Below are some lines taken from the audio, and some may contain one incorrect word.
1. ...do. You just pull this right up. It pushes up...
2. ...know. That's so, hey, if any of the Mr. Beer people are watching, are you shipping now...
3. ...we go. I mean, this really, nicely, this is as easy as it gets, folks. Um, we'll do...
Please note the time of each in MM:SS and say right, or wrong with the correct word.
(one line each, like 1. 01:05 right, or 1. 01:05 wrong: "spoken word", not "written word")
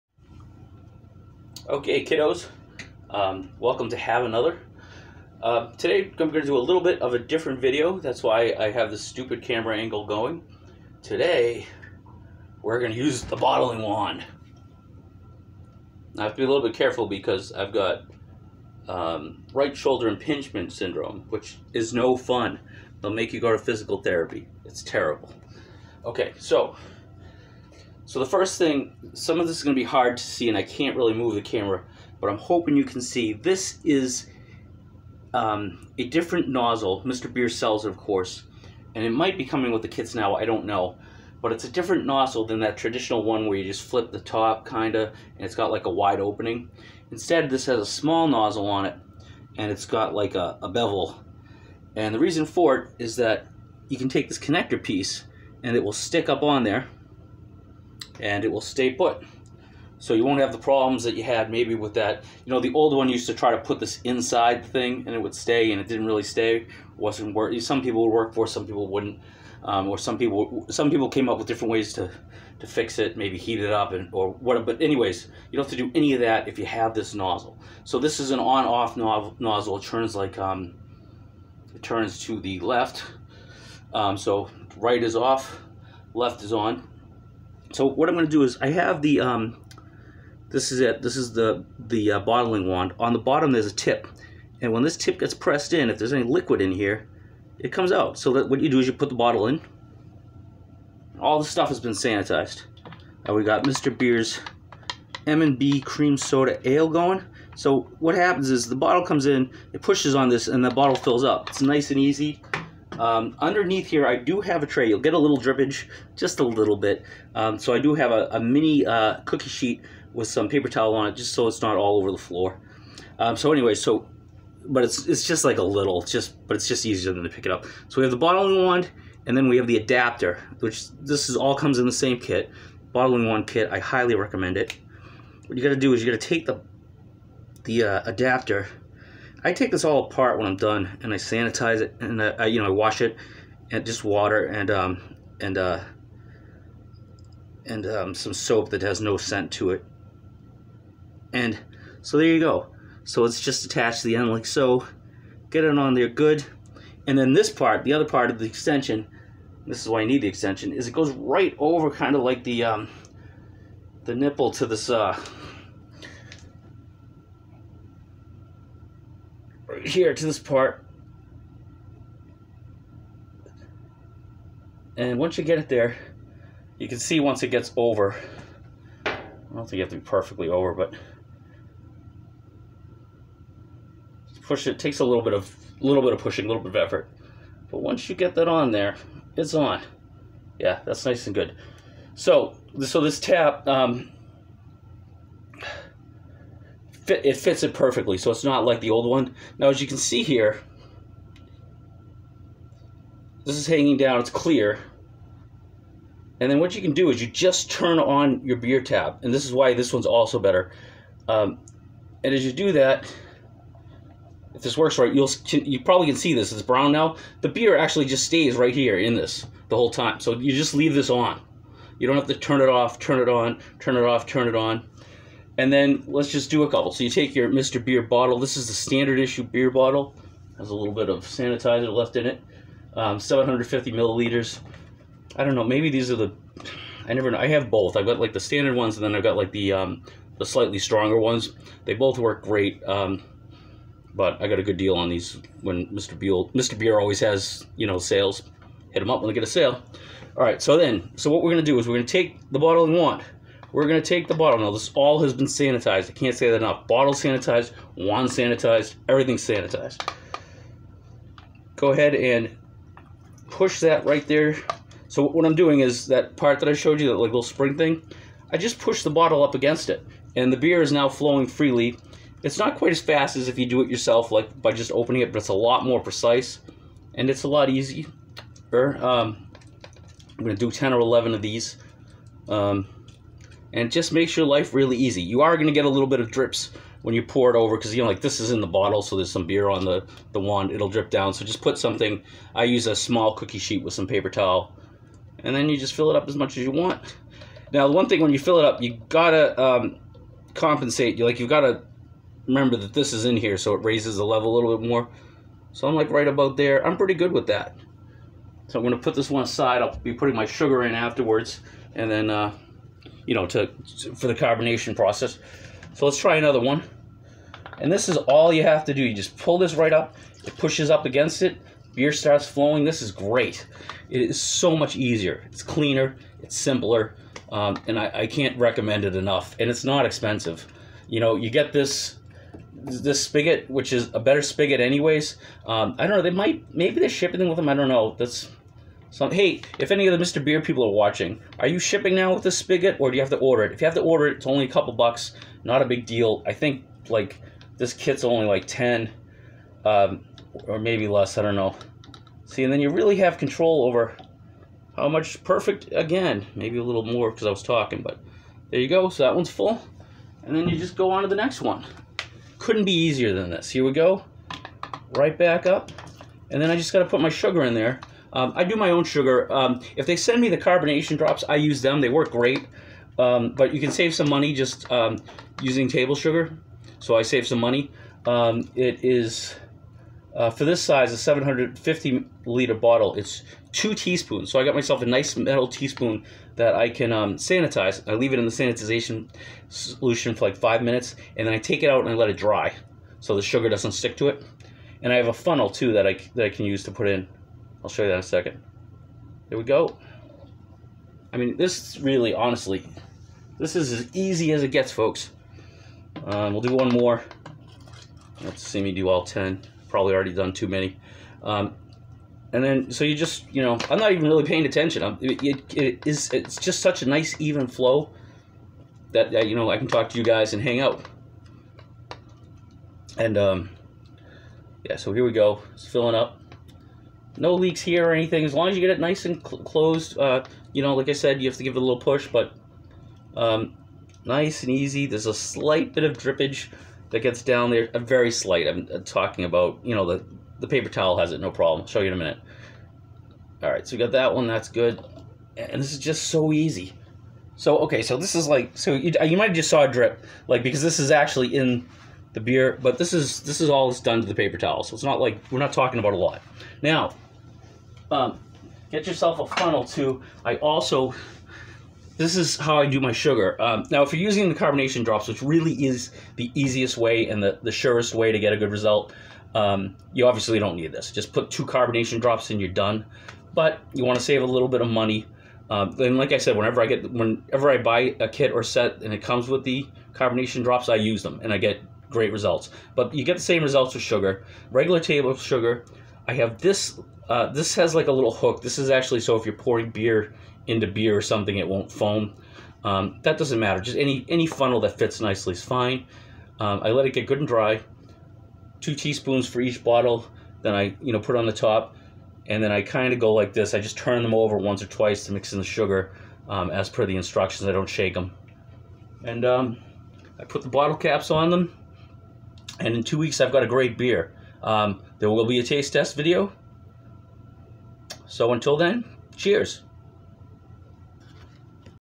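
1. 05:18 right
2. 05:37 right
3. 06:39 wrong: "honestly", not "nicely".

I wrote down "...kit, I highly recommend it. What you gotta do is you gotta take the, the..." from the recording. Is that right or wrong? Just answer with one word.
right.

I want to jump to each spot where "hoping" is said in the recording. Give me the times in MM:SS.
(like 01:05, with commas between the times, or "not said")
00:32.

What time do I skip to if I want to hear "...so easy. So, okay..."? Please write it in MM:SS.
07:26.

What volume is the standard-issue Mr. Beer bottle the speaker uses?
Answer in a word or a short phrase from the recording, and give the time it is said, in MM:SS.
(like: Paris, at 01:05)
750 milliliters, at 03:53.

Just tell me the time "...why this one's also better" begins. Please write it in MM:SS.
03:29.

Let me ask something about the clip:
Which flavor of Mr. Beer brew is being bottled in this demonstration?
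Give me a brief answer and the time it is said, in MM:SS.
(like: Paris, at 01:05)
M&B cream soda ale, at 01:45.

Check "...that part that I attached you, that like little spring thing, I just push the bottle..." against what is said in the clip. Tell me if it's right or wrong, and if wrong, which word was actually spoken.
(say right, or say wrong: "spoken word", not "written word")
wrong: "showed", not "attached".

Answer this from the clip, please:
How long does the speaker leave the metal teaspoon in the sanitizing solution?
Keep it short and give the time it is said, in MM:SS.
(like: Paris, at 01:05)
5 minutes, at 06:30.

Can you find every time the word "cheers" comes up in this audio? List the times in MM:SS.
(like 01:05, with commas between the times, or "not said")
08:39.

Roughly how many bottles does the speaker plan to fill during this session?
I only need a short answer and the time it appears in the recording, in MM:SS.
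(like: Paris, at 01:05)
10 or 11, at 04:40.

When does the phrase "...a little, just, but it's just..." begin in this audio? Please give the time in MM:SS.
02:05.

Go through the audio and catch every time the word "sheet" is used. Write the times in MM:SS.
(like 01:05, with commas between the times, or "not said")
01:59, 04:53.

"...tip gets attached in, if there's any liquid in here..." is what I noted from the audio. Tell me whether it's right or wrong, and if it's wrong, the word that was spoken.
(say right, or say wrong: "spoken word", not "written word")
wrong: "pressed", not "attached".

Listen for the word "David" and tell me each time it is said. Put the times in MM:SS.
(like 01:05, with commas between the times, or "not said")
not said.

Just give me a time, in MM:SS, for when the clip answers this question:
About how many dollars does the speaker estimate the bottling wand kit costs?
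05:48.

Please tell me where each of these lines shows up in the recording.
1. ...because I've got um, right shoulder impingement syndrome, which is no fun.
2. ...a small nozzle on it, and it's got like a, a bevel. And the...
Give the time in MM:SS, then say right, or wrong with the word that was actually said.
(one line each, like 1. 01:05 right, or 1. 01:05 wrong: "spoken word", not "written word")
1. 00:17 right
2. 00:47 right.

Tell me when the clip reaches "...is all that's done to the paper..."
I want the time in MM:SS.
07:33.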